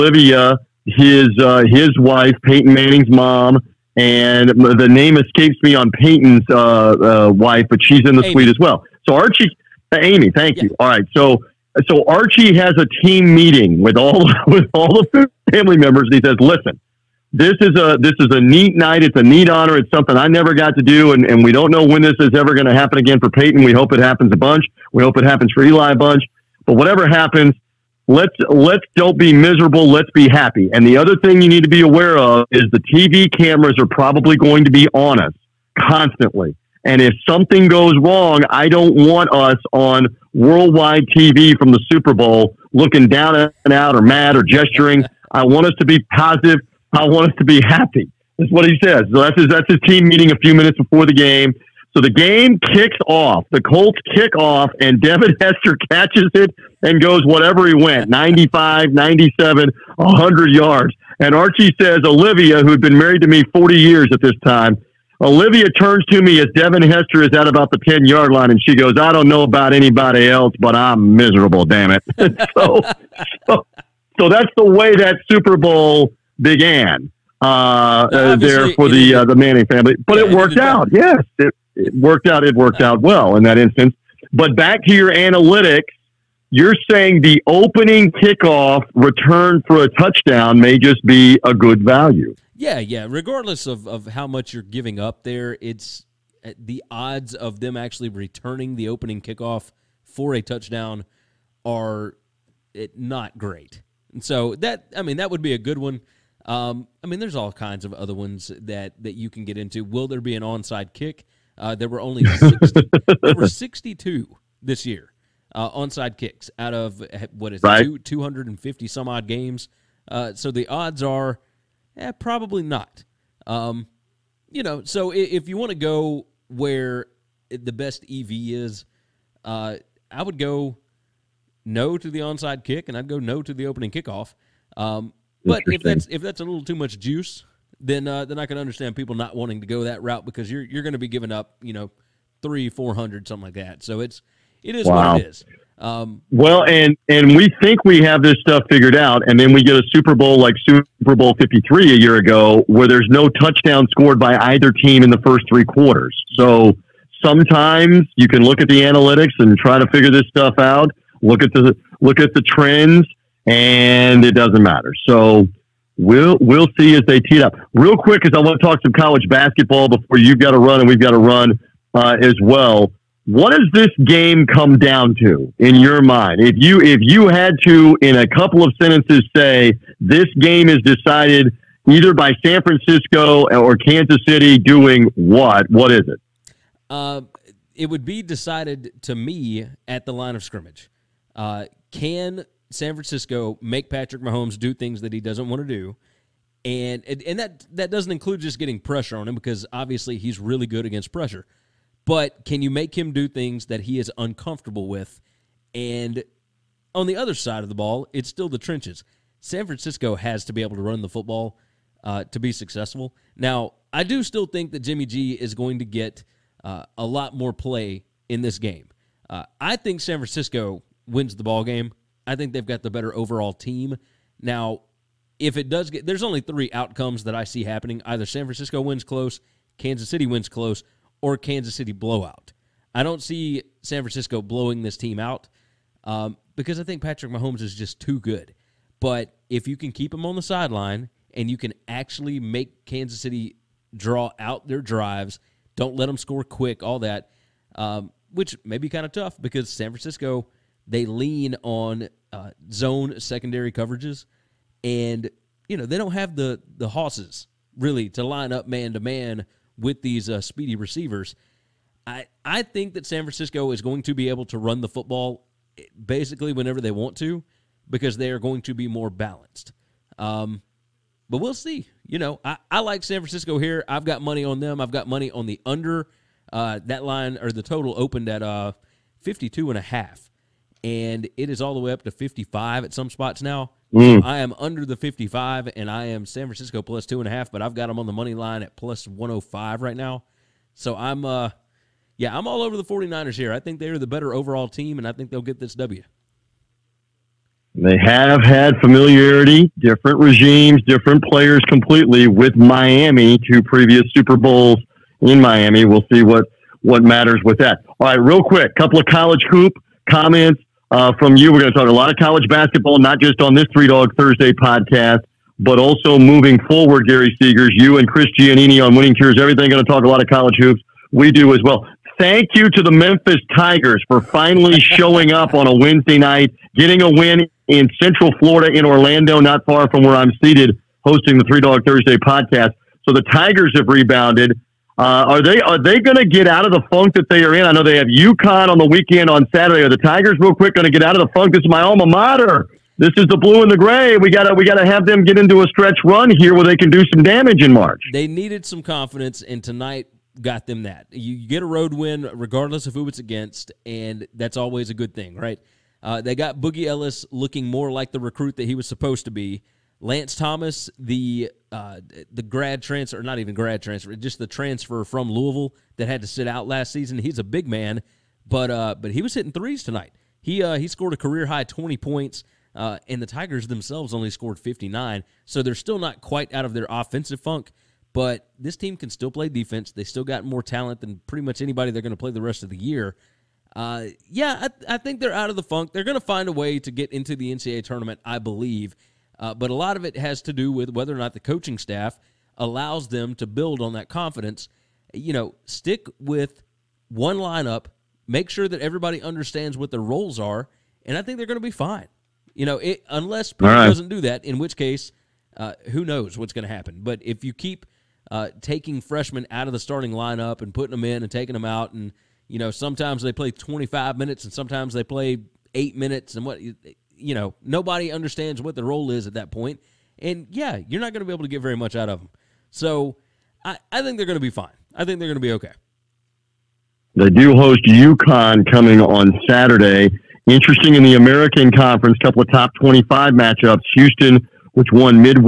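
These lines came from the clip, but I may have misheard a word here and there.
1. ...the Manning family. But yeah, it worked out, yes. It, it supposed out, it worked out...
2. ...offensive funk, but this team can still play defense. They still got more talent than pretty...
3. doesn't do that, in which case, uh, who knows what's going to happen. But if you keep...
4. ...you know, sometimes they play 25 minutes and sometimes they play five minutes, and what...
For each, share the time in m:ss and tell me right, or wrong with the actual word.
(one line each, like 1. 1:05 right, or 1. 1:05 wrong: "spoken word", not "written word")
1. 1:19 wrong: "worked", not "supposed"
2. 6:16 right
3. 6:43 right
4. 6:52 wrong: "eight", not "five".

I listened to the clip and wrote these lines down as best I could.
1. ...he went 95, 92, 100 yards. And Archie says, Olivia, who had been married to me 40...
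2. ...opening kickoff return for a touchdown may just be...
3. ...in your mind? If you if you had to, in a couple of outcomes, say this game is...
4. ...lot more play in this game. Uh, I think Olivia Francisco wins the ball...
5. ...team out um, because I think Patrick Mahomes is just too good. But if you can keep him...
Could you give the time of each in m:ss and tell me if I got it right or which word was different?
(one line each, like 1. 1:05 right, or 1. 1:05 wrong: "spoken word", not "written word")
1. 0:57 wrong: "97", not "92"
2. 1:27 right
3. 2:55 wrong: "sentences", not "outcomes"
4. 3:37 wrong: "San", not "Olivia"
5. 3:54 right.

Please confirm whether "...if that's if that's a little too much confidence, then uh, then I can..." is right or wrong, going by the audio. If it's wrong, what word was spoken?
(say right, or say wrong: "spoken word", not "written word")
wrong: "juice", not "confidence".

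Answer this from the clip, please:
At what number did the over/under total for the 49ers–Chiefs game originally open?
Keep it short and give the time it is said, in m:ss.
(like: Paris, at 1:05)
52.5, at 4:39.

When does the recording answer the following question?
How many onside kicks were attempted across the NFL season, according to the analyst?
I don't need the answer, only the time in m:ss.
1:53.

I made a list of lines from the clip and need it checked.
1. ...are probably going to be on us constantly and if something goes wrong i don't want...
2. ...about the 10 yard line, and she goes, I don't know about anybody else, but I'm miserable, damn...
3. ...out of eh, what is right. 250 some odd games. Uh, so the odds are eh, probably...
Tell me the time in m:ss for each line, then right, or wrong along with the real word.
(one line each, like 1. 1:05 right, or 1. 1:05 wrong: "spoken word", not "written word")
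1. 0:33 right
2. 1:07 right
3. 1:56 right.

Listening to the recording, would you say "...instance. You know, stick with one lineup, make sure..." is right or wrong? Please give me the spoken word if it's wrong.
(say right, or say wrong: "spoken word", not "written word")
wrong: "confidence", not "instance".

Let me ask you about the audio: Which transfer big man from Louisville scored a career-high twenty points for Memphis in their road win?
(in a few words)
Lance Thomas.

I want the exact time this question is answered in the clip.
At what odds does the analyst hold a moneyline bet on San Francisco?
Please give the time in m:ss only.
4:48.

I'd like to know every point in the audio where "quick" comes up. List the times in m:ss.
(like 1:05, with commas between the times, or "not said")
2:47, 4:06, 5:08, 5:40.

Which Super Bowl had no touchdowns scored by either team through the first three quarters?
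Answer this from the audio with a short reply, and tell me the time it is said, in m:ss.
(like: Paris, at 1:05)
Super Bowl 53, at 2:30.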